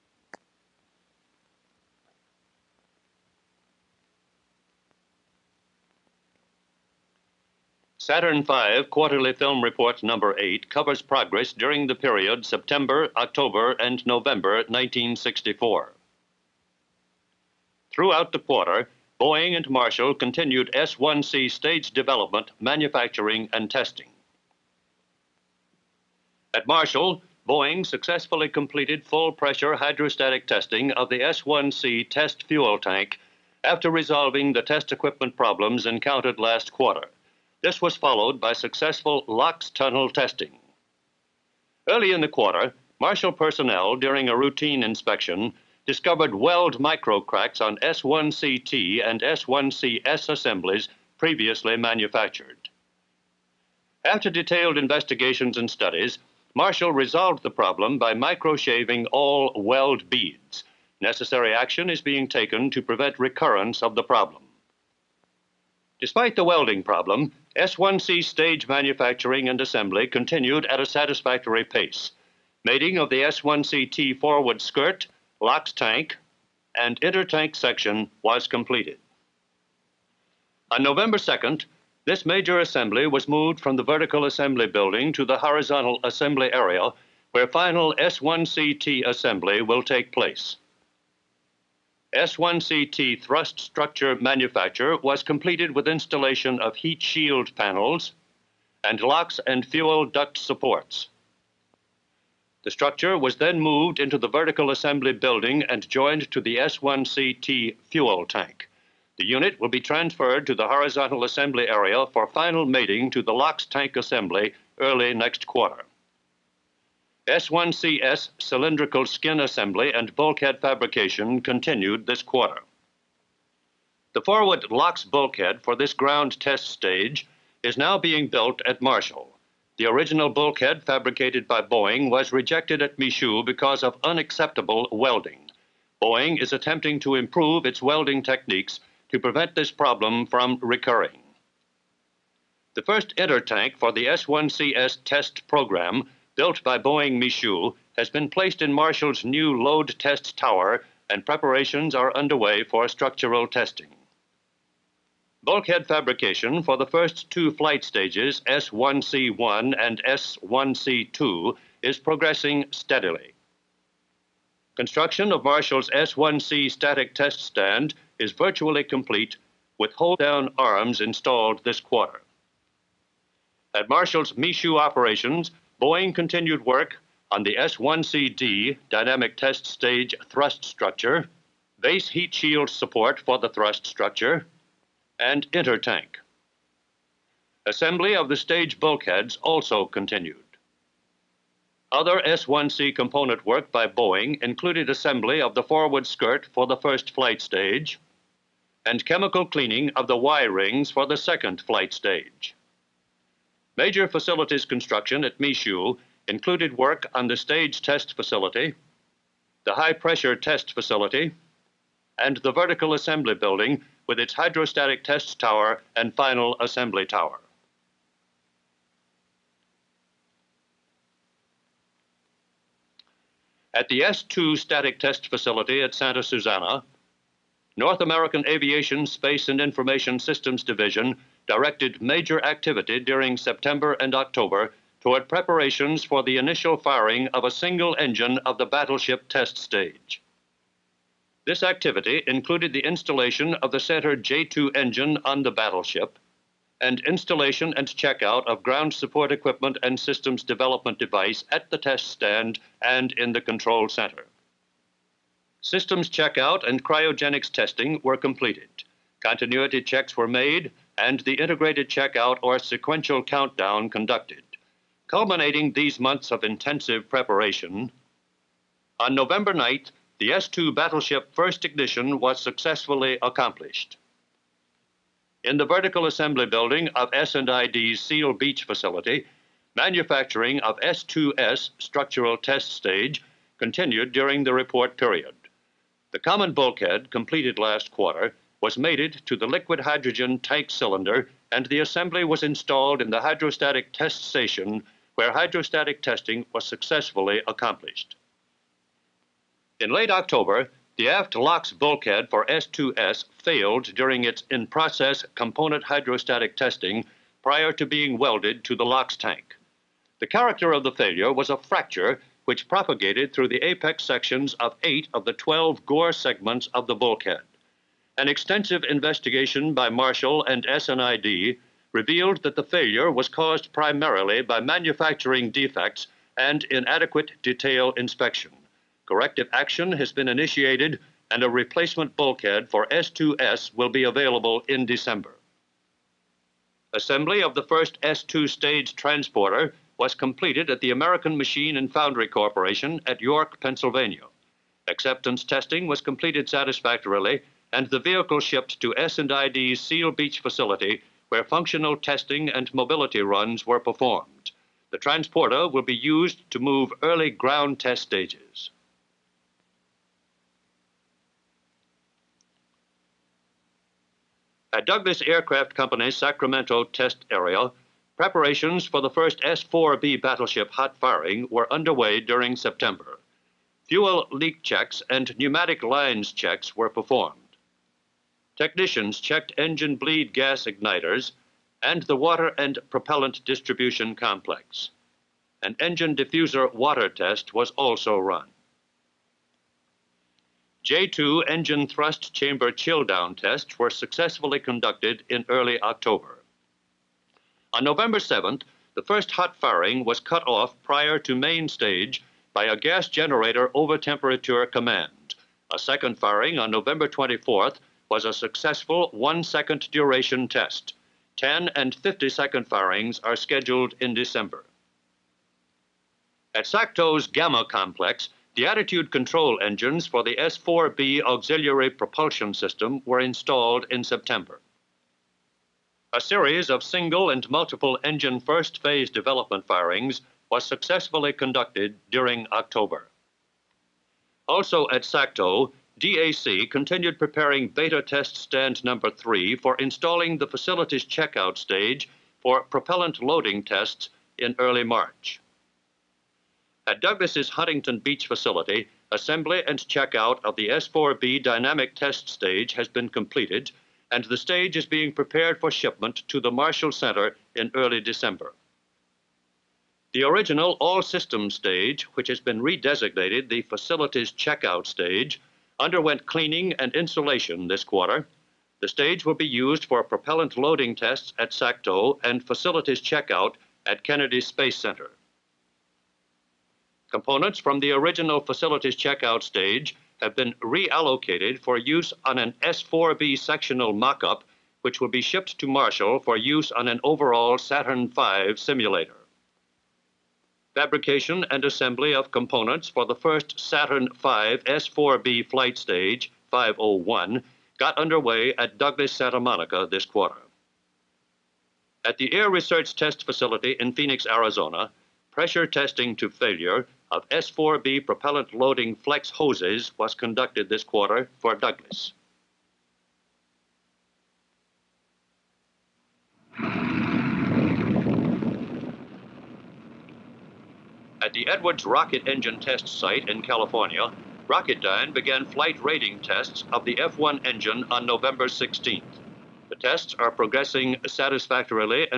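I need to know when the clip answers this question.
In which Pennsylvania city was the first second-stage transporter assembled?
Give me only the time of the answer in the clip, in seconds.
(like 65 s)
343 s.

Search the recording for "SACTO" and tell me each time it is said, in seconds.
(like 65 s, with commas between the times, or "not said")
416 s, 435 s, 471 s.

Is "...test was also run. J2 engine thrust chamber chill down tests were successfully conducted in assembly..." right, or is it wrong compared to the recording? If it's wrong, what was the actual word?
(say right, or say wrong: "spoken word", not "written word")
wrong: "early", not "assembly".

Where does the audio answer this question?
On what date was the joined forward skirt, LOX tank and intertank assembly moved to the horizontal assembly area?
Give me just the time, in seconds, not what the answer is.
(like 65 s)
80 s.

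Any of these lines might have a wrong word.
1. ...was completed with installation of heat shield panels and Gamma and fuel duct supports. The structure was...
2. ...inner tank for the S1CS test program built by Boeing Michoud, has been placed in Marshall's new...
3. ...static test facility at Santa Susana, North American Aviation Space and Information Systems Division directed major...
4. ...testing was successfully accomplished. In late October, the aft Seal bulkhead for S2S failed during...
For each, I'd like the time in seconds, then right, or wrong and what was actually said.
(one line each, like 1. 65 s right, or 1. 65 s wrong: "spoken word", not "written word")
1. 94 s wrong: "LOX", not "Gamma"
2. 143 s right
3. 224 s right
4. 296 s wrong: "LOX", not "Seal".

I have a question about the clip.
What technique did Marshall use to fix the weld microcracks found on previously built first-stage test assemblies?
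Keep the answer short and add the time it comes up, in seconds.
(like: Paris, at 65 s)
Microshaving, at 58 s.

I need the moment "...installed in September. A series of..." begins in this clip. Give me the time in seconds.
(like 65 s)
423 s.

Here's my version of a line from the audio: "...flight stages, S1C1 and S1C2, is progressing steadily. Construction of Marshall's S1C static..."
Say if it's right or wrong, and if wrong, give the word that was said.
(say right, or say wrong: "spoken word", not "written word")
right.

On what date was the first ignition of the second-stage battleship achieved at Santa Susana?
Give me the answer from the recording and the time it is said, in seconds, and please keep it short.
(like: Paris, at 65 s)
November 9, at 269 s.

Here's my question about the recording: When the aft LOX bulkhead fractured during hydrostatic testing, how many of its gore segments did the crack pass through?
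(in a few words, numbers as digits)
8.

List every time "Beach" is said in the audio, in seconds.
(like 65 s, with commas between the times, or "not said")
278 s, 350 s, 447 s.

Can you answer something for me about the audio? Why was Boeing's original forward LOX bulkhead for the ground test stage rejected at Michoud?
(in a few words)
Unacceptable welding.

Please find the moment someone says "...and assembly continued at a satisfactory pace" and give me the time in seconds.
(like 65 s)
69 s.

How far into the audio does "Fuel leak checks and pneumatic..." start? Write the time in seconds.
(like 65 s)
373 s.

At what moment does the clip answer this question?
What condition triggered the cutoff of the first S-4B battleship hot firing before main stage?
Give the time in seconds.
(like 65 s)
402 s.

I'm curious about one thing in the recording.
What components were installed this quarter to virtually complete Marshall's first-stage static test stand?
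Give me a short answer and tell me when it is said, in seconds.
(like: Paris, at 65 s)
Hold-down arms, at 169 s.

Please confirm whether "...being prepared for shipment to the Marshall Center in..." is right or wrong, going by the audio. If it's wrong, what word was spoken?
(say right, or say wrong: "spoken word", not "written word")
right.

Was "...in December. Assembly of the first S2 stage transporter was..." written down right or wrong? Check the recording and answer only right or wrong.
right.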